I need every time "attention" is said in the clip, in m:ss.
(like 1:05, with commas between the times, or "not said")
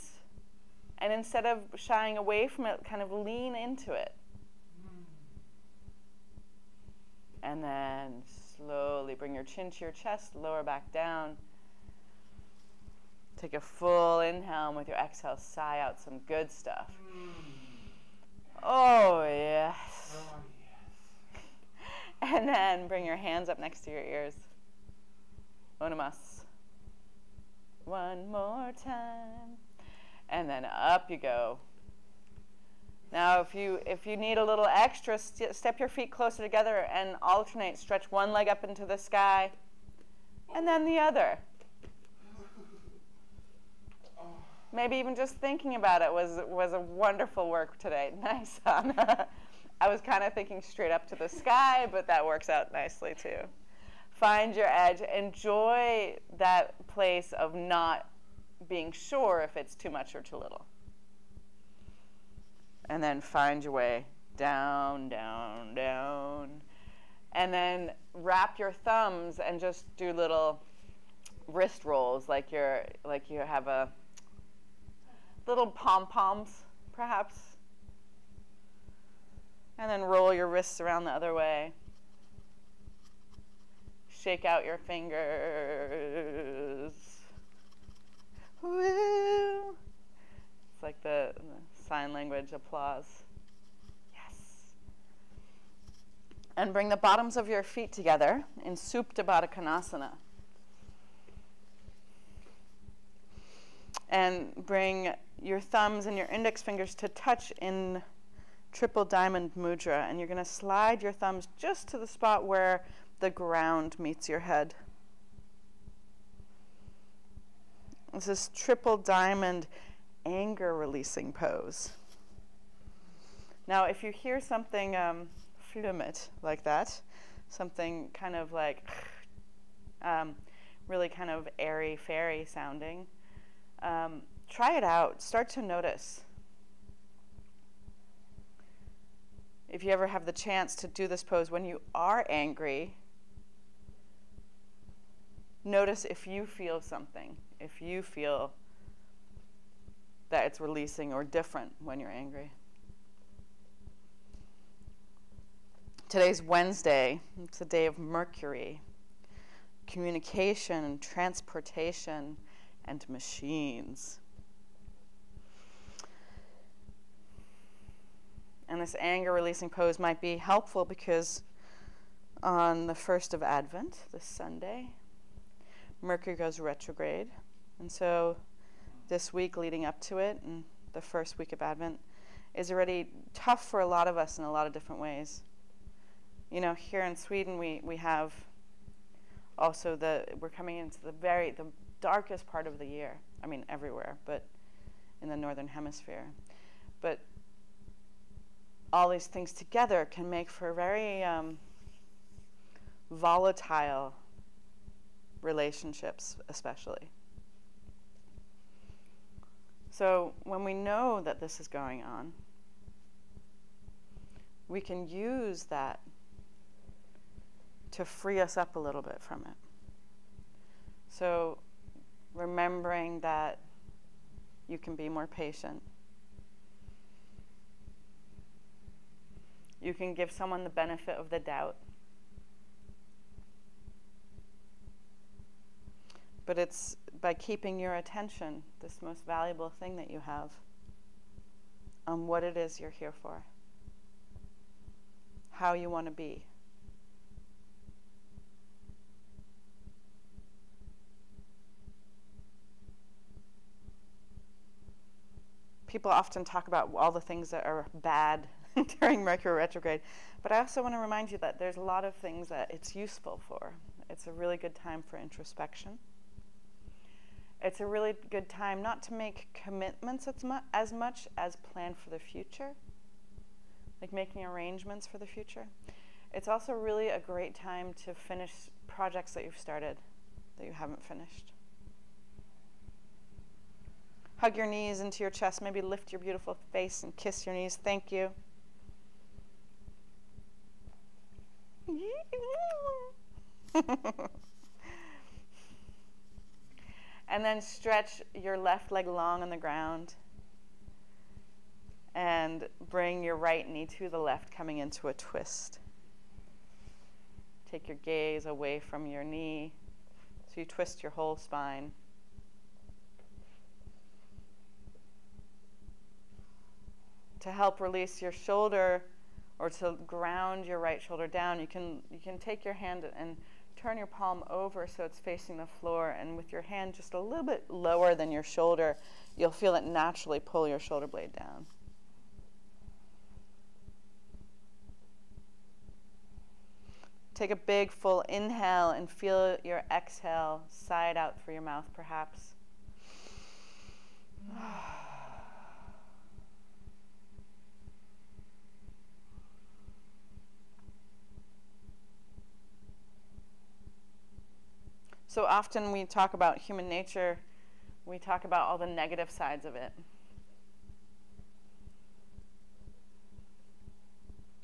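3:57.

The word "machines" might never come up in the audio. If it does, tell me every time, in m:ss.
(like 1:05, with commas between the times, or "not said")
2:43.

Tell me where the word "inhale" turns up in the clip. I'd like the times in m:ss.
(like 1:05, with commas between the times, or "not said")
0:14, 5:38.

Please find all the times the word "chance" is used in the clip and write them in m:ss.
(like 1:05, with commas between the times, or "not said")
2:20.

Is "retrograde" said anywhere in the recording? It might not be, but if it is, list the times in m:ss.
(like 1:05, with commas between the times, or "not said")
2:56, 4:19.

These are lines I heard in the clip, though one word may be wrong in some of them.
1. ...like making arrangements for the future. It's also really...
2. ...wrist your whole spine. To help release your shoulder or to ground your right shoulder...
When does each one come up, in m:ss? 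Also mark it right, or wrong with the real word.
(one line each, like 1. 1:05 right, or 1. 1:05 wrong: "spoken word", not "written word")
1. 4:34 right
2. 5:10 wrong: "twist", not "wrist".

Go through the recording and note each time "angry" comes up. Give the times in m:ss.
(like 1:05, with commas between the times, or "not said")
2:22, 2:32.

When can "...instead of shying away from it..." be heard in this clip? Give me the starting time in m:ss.
0:01.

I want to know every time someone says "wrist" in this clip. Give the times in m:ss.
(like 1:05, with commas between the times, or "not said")
1:11, 1:20.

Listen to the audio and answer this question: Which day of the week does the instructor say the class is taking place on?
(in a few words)
Wednesday.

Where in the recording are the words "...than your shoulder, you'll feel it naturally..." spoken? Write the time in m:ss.
5:28.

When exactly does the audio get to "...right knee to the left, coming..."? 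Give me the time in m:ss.
5:03.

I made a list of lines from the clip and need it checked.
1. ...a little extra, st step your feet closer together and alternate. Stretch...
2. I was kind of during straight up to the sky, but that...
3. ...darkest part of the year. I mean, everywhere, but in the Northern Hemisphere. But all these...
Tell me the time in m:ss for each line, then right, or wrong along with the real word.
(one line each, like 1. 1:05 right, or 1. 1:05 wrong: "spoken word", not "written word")
1. 0:34 right
2. 0:49 wrong: "thinking", not "during"
3. 3:11 right.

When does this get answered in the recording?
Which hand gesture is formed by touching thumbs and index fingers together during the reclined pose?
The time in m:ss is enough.
1:48.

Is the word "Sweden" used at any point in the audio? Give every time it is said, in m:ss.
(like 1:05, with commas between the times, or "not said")
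3:07.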